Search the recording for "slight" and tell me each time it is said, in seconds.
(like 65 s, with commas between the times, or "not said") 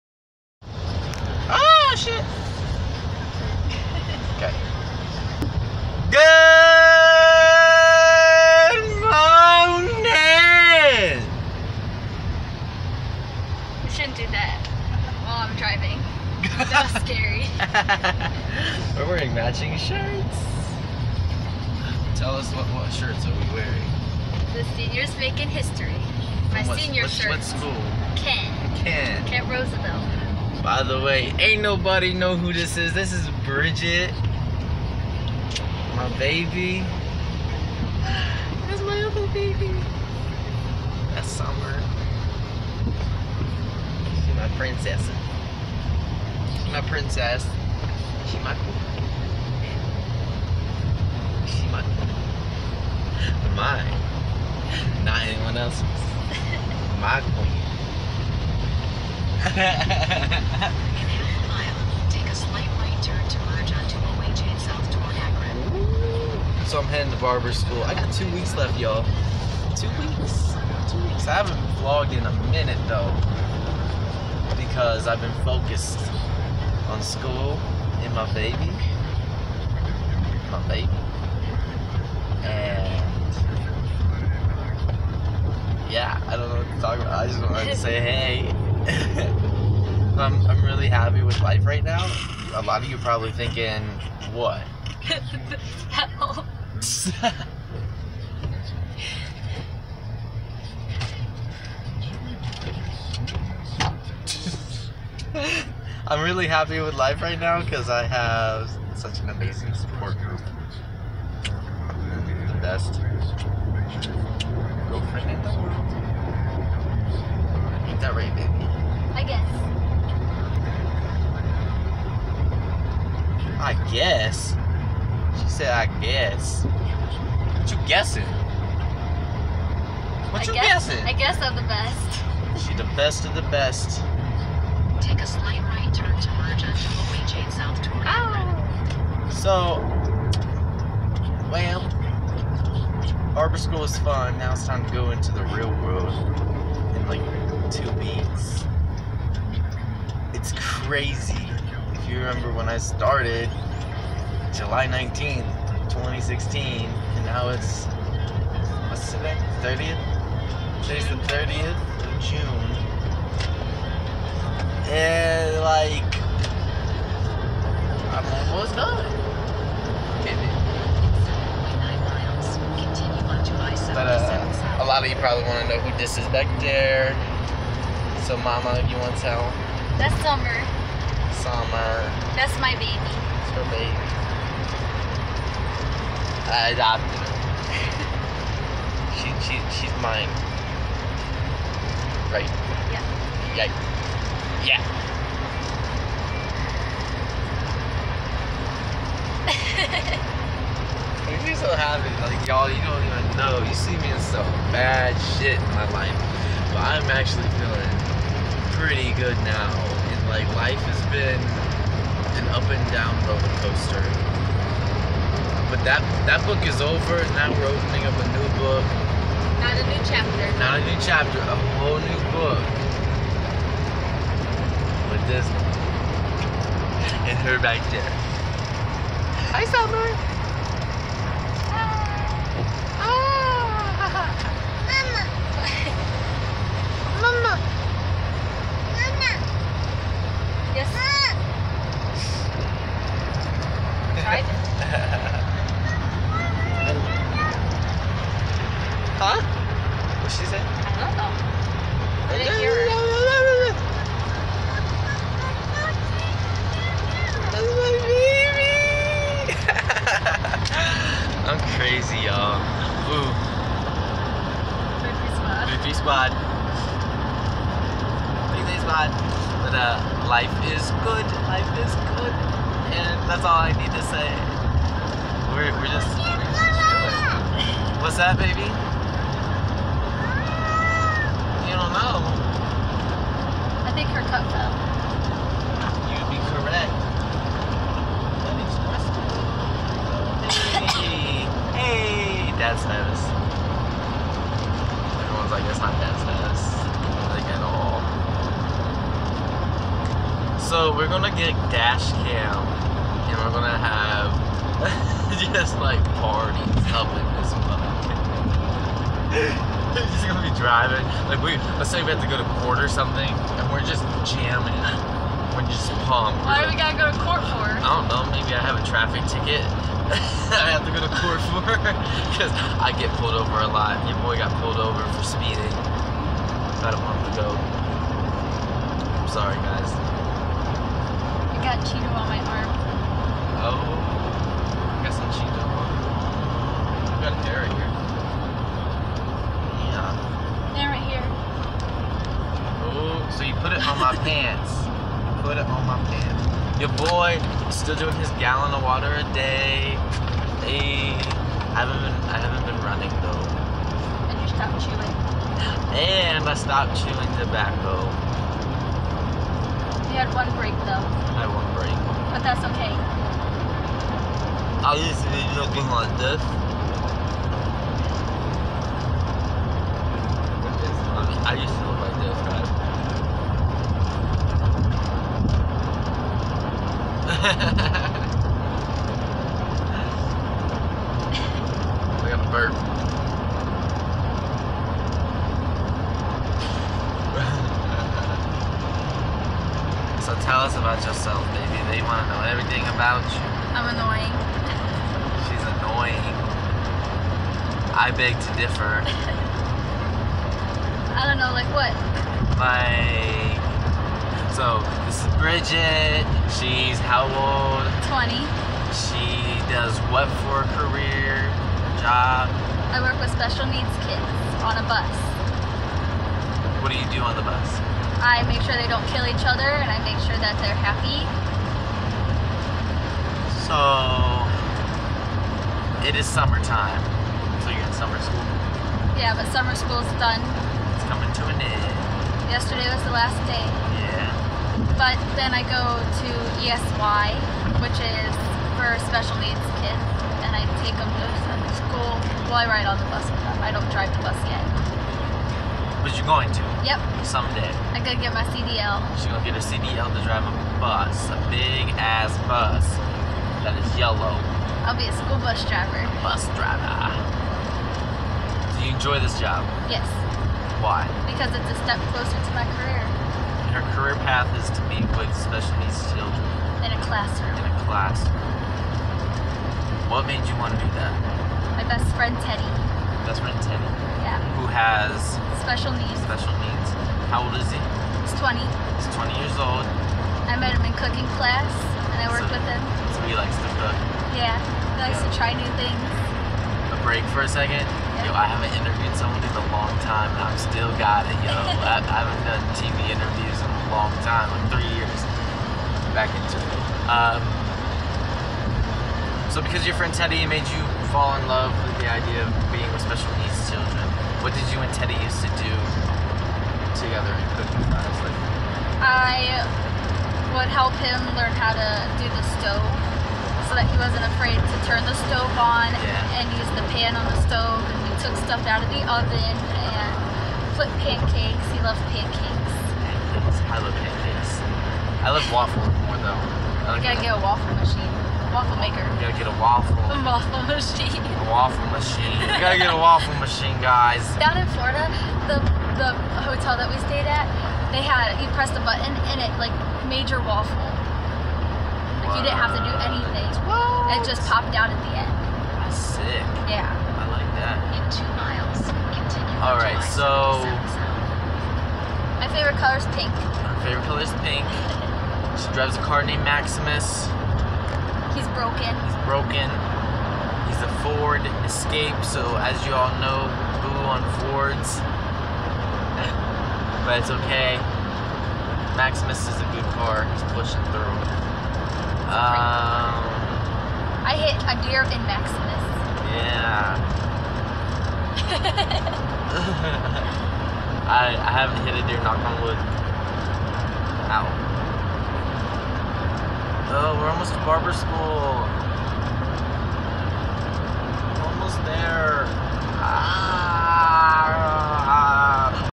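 62 s, 135 s.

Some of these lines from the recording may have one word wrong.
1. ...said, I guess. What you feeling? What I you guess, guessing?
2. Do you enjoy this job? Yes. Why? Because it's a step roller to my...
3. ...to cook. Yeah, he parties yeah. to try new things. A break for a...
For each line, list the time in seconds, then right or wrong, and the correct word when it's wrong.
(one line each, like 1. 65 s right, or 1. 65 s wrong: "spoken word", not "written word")
1. 125 s wrong: "guessing", not "feeling"
2. 458 s wrong: "closer", not "roller"
3. 483 s wrong: "likes", not "parties".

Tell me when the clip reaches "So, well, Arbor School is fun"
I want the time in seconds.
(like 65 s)
139 s.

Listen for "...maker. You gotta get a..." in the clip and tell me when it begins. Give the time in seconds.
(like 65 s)
528 s.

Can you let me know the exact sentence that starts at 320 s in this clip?
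I have to go to court for because I get pulled over a lot.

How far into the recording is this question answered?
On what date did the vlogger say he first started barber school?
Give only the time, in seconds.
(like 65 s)
154 s.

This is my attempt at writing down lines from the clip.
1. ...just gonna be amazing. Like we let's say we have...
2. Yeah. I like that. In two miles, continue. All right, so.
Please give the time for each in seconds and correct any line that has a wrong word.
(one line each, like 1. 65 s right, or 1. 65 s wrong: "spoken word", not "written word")
1. 310 s wrong: "driving", not "amazing"
2. 546 s right.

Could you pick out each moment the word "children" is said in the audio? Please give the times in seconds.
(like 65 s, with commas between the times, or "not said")
466 s, 503 s.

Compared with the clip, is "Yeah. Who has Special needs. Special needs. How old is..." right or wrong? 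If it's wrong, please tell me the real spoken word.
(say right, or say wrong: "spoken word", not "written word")
right.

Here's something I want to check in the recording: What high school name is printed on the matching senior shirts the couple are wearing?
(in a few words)
Kent Roosevelt.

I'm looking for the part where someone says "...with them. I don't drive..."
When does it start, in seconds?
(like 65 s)
443 s.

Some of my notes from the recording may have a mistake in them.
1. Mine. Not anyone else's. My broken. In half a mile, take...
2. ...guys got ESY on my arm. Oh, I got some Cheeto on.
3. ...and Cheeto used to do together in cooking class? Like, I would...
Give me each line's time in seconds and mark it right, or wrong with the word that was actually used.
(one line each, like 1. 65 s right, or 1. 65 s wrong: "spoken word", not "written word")
1. 53 s wrong: "queen", not "broken"
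2. 329 s wrong: "Cheeto", not "ESY"
3. 504 s wrong: "Teddy", not "Cheeto".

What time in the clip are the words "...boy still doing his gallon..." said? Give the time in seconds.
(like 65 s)
347 s.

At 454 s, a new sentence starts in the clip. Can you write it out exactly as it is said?
I'll be a school bus driver.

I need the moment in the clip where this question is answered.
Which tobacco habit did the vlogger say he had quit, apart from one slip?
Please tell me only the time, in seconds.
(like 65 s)
356 s.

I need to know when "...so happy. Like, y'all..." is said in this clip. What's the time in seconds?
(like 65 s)
201 s.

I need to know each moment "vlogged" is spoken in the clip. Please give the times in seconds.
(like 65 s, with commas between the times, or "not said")
71 s.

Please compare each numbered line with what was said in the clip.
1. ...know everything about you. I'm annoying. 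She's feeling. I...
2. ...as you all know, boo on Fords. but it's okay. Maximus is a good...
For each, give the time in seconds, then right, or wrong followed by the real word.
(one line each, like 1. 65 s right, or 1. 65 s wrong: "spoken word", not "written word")
1. 392 s wrong: "annoying", not "feeling"
2. 562 s right.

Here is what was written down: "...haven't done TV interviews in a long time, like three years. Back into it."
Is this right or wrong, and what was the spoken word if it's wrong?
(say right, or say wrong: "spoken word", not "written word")
right.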